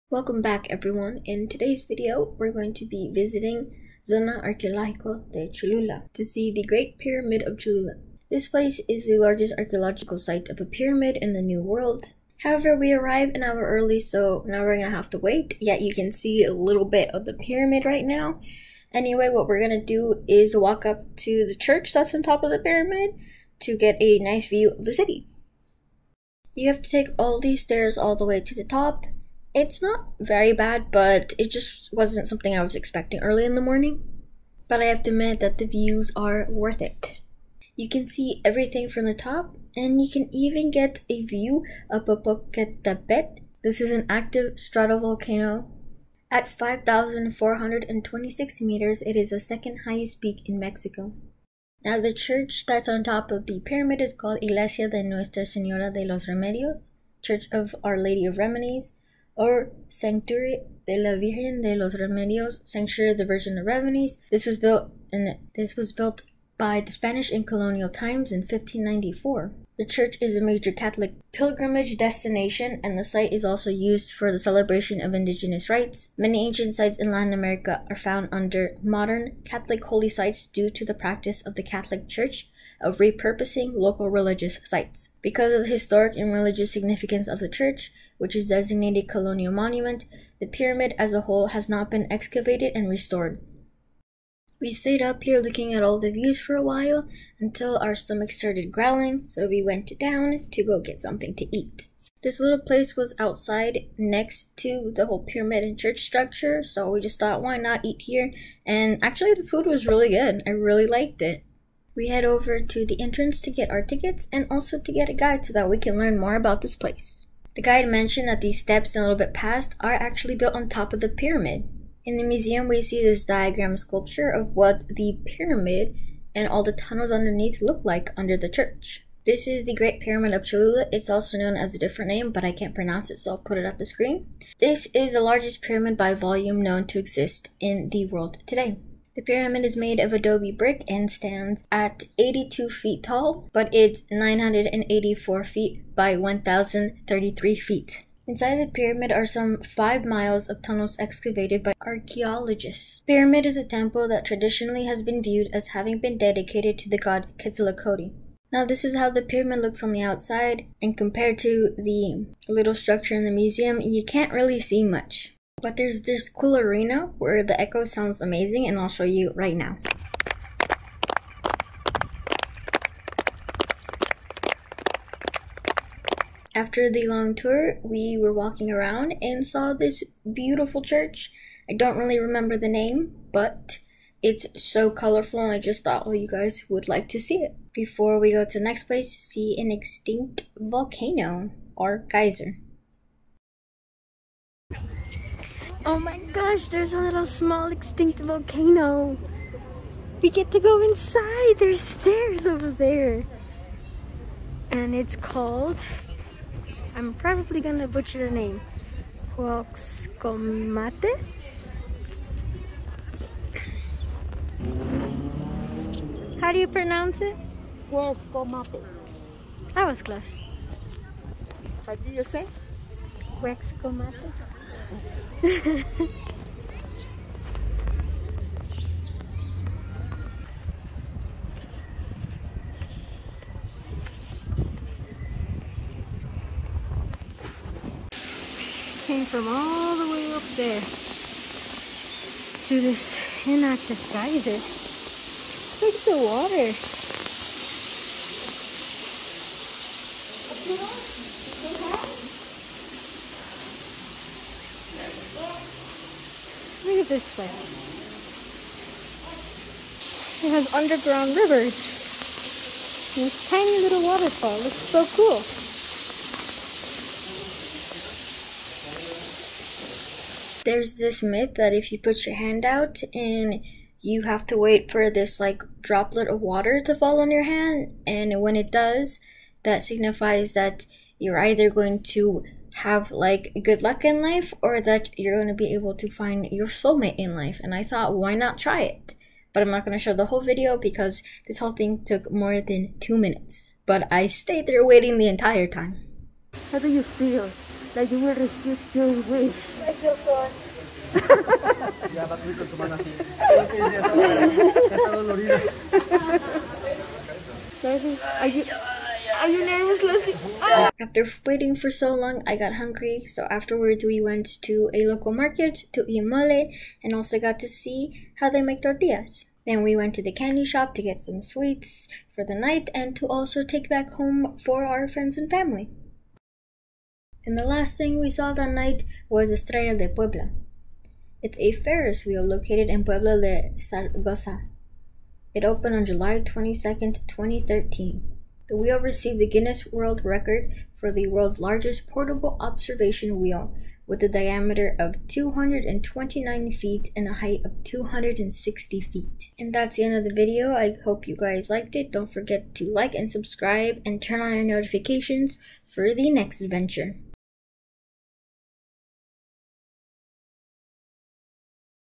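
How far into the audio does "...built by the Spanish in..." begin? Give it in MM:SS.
01:05.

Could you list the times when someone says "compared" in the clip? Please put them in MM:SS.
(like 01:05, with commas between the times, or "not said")
02:40.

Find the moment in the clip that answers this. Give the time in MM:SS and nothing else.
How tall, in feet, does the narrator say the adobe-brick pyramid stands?
02:22.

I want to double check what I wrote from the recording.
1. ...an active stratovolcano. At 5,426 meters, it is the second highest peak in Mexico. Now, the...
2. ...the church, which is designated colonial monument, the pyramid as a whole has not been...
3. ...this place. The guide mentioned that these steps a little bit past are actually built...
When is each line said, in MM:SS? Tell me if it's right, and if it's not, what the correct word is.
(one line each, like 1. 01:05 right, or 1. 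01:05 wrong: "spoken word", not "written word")
1. 00:43 right
2. 01:27 right
3. 01:56 right.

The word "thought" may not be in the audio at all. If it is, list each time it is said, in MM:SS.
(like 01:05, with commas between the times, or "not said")
01:47, 03:05, 04:47.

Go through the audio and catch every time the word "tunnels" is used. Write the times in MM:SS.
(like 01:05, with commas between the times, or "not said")
02:06, 02:30.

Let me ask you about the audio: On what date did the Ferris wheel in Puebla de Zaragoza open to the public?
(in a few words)
July 22, 2013.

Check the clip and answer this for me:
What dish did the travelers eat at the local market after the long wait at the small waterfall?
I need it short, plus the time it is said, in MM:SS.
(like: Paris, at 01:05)
mole, at 05:16.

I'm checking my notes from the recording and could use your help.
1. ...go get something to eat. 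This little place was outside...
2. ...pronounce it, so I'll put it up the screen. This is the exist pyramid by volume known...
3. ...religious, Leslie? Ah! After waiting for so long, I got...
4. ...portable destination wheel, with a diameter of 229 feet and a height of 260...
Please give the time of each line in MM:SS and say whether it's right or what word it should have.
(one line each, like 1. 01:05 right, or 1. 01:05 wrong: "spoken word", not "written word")
1. 01:40 right
2. 02:12 wrong: "largest", not "exist"
3. 05:09 wrong: "nervous", not "religious"
4. 05:42 wrong: "observation", not "destination".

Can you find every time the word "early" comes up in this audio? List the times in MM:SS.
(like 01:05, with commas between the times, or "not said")
00:13, 00:33.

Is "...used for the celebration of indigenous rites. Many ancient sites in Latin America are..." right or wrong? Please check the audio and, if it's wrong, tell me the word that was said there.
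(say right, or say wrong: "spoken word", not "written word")
right.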